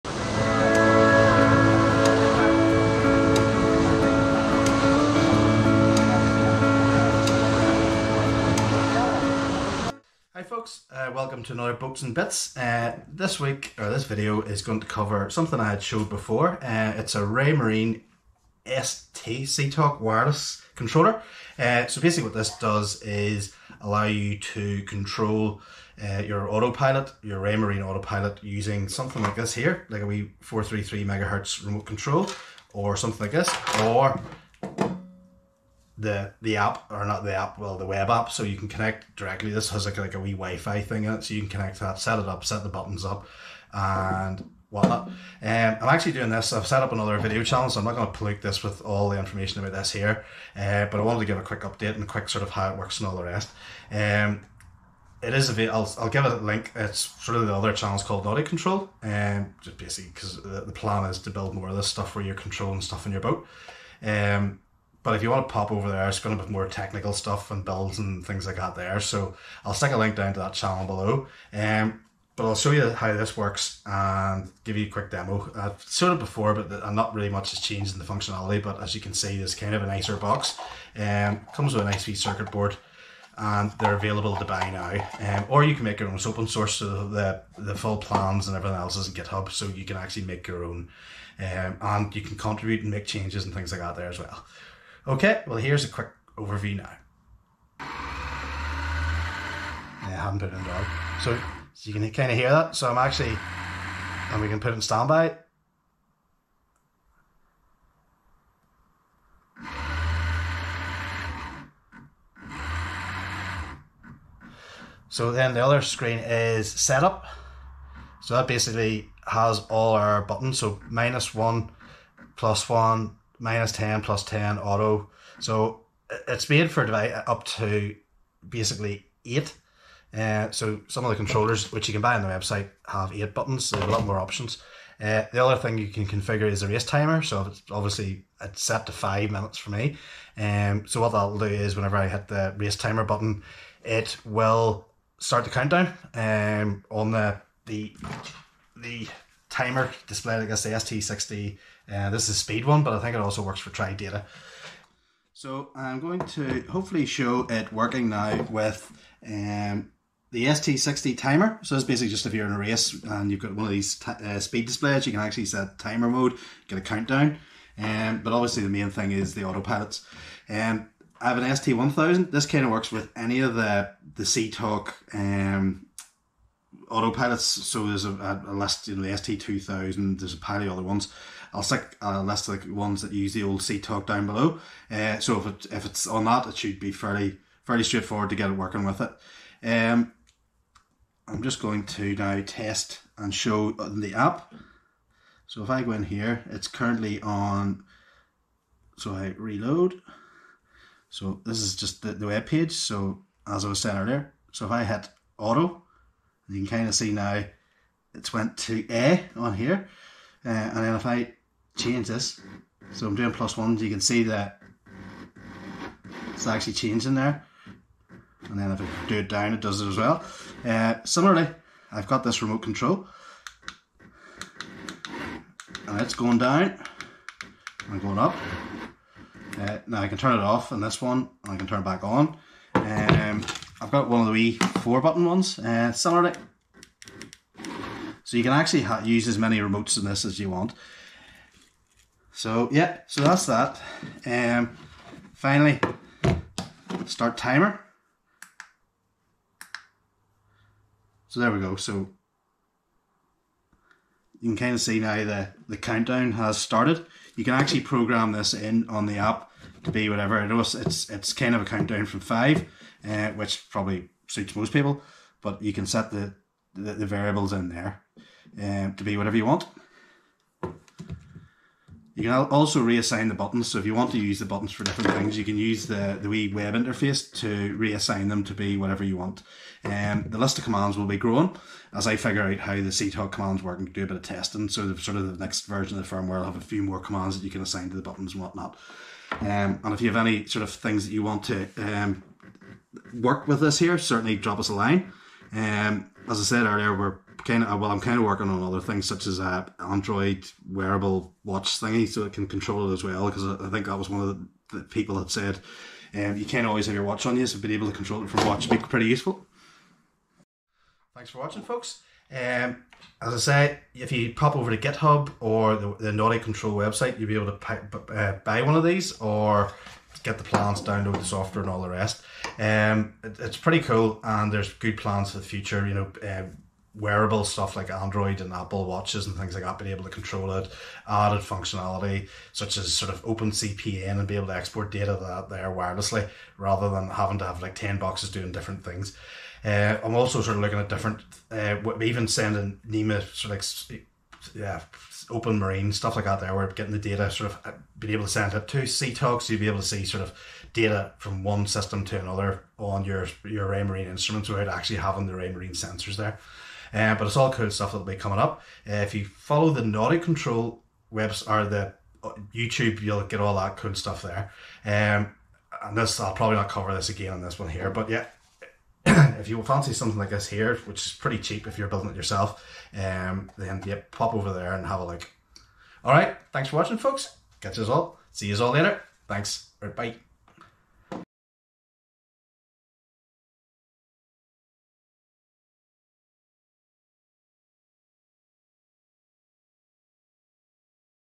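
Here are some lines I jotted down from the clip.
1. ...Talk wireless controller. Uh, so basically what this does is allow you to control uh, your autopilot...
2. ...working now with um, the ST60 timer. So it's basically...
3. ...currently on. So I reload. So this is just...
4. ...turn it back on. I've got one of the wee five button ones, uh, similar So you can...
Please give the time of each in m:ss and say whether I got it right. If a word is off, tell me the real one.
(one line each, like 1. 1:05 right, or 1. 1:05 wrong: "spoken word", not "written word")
1. 0:19 right
2. 2:37 right
3. 3:16 right
4. 3:51 wrong: "four", not "five".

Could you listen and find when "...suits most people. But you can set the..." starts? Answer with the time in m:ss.
4:24.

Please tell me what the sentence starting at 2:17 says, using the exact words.
So it's obviously it's set to five minutes for me.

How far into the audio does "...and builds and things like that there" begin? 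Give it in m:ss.
1:07.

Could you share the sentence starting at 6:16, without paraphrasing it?
All right, thanks for watching, folks.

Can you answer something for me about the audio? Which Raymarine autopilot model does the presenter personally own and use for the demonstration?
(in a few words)
ST1000.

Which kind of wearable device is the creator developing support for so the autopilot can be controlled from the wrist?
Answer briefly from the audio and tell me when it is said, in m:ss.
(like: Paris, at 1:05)
Android wearable watch, at 4:59.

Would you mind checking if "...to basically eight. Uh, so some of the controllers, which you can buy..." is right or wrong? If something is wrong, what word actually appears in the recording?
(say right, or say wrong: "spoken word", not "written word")
right.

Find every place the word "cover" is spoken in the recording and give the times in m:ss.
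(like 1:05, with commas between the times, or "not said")
0:14, 6:06.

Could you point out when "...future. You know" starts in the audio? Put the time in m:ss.
5:25.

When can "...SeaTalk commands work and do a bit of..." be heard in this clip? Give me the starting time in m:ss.
4:42.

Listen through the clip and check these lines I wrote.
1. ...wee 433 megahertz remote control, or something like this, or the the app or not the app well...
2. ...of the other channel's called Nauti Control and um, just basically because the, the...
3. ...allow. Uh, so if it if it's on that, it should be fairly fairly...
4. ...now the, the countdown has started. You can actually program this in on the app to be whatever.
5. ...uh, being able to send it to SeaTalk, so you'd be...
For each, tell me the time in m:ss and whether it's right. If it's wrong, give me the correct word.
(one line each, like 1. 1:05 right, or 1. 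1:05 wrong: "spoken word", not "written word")
1. 0:30 right
2. 0:57 right
3. 3:04 wrong: "below", not "allow"
4. 4:15 right
5. 5:47 right.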